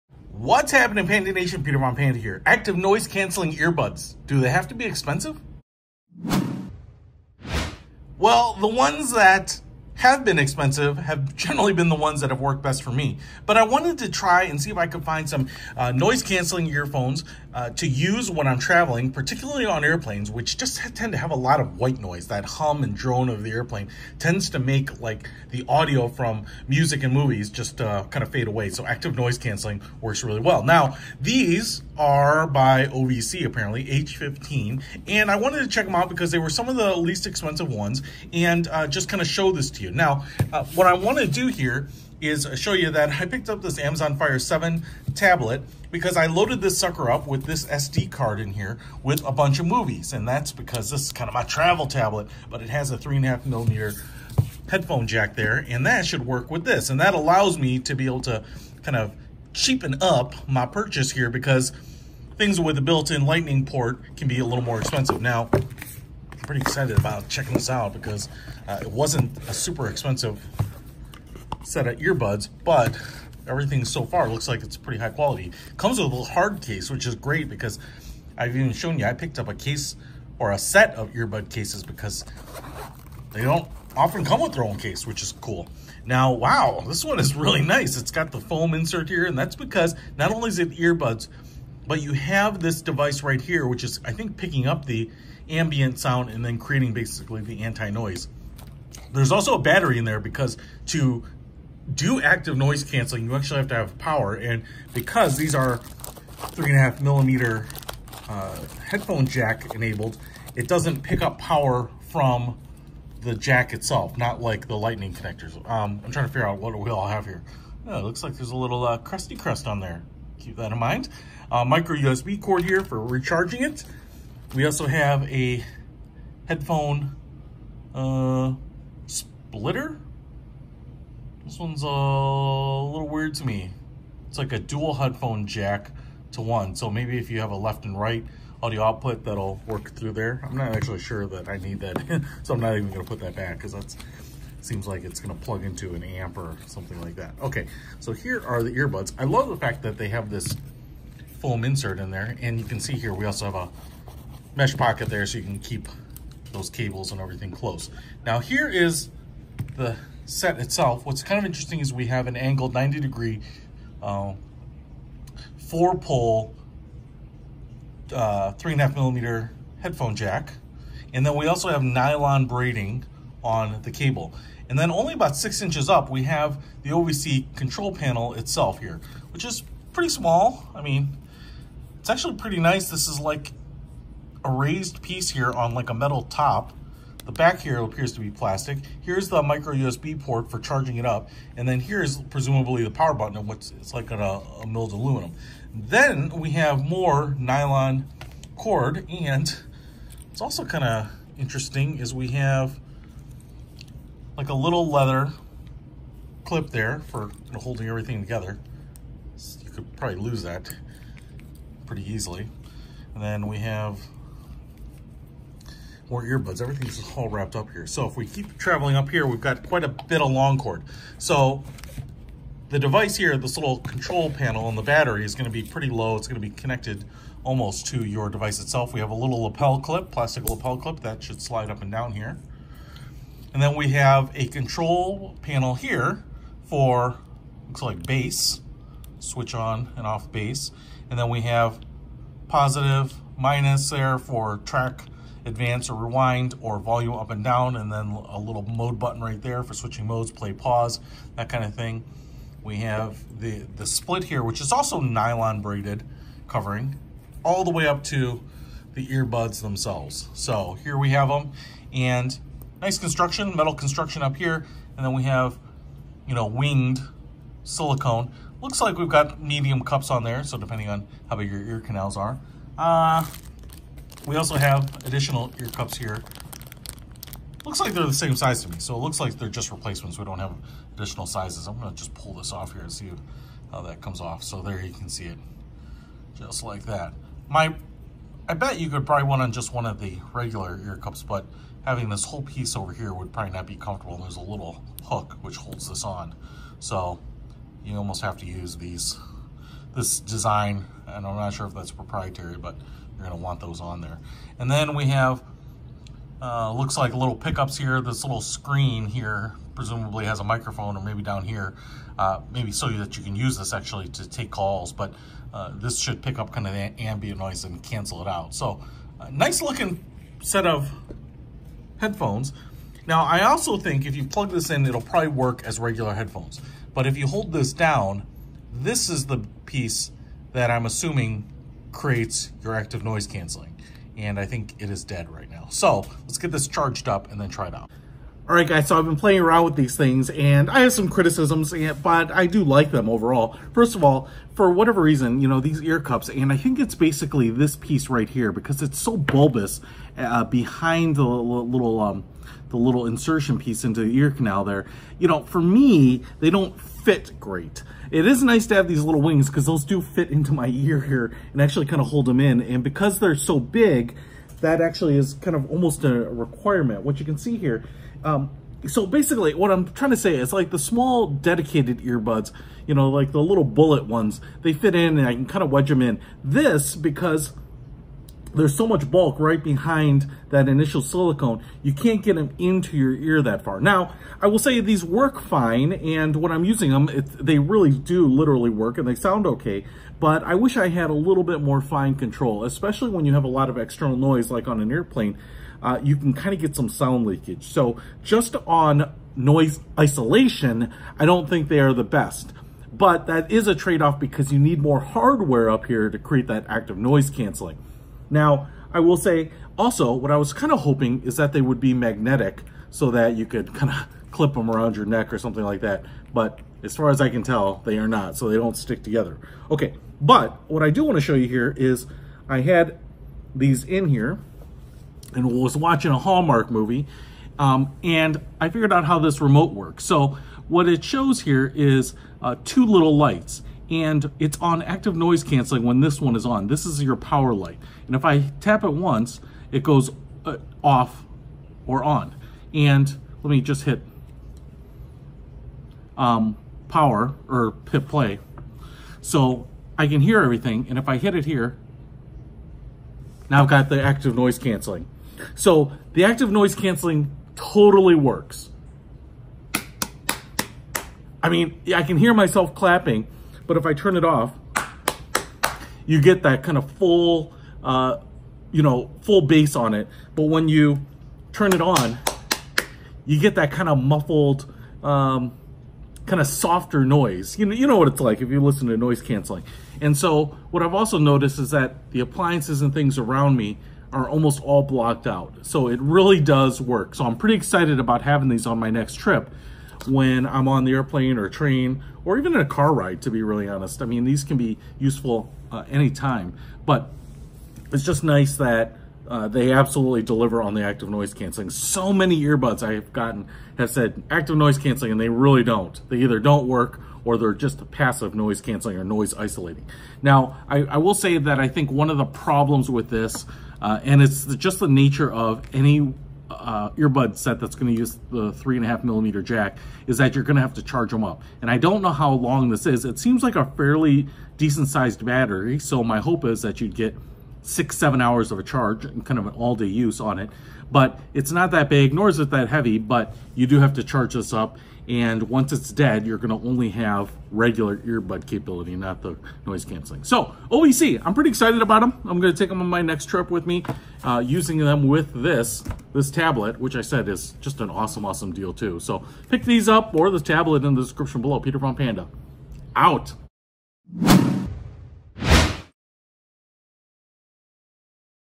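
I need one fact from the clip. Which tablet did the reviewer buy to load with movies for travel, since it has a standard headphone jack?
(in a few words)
Amazon Fire 7.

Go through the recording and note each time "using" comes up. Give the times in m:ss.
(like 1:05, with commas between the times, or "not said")
6:26, 9:04.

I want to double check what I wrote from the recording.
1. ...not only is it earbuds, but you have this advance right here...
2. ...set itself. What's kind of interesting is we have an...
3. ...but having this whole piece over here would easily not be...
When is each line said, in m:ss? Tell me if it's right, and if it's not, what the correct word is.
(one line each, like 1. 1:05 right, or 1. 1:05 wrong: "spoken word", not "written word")
1. 1:30 wrong: "device", not "advance"
2. 2:40 right
3. 4:51 wrong: "probably", not "easily".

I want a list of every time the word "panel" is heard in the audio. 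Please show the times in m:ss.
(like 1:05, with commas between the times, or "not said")
2:57, 3:44, 3:55.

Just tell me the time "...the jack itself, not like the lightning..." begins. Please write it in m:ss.
1:53.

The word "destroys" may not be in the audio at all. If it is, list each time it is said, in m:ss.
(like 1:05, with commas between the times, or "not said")
not said.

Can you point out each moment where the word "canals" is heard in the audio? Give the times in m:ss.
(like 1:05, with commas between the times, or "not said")
4:31, 5:54.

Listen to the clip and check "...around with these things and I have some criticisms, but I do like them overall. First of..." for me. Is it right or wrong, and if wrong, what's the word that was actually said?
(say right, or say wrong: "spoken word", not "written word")
right.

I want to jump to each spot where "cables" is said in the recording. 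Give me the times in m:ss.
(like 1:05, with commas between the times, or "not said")
2:36, 2:53.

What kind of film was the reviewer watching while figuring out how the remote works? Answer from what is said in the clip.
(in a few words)
Hallmark movie.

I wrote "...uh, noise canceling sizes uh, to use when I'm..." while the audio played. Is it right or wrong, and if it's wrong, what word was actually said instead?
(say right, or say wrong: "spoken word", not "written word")
wrong: "earphones", not "sizes".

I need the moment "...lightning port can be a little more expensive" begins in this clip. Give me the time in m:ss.
1:03.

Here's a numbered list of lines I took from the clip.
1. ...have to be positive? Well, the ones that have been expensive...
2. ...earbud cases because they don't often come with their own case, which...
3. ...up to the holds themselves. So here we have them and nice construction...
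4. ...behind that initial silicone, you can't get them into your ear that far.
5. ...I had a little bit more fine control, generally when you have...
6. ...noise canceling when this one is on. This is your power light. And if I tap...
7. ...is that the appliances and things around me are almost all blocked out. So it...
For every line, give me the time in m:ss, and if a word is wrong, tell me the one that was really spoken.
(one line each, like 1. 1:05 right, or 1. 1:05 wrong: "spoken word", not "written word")
1. 0:04 wrong: "expensive", not "positive"
2. 1:21 right
3. 4:17 wrong: "earbuds", not "holds"
4. 6:19 right
5. 6:30 wrong: "especially", not "generally"
6. 7:15 right
7. 8:01 right.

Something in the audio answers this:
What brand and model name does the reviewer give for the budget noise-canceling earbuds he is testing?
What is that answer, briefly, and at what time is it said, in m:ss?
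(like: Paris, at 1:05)
OVC H15, at 0:32.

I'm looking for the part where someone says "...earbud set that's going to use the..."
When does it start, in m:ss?
8:36.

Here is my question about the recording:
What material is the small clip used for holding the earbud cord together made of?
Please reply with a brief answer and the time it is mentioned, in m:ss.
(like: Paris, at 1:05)
leather, at 3:24.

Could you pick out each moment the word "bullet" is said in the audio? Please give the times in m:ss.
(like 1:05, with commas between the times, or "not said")
6:13.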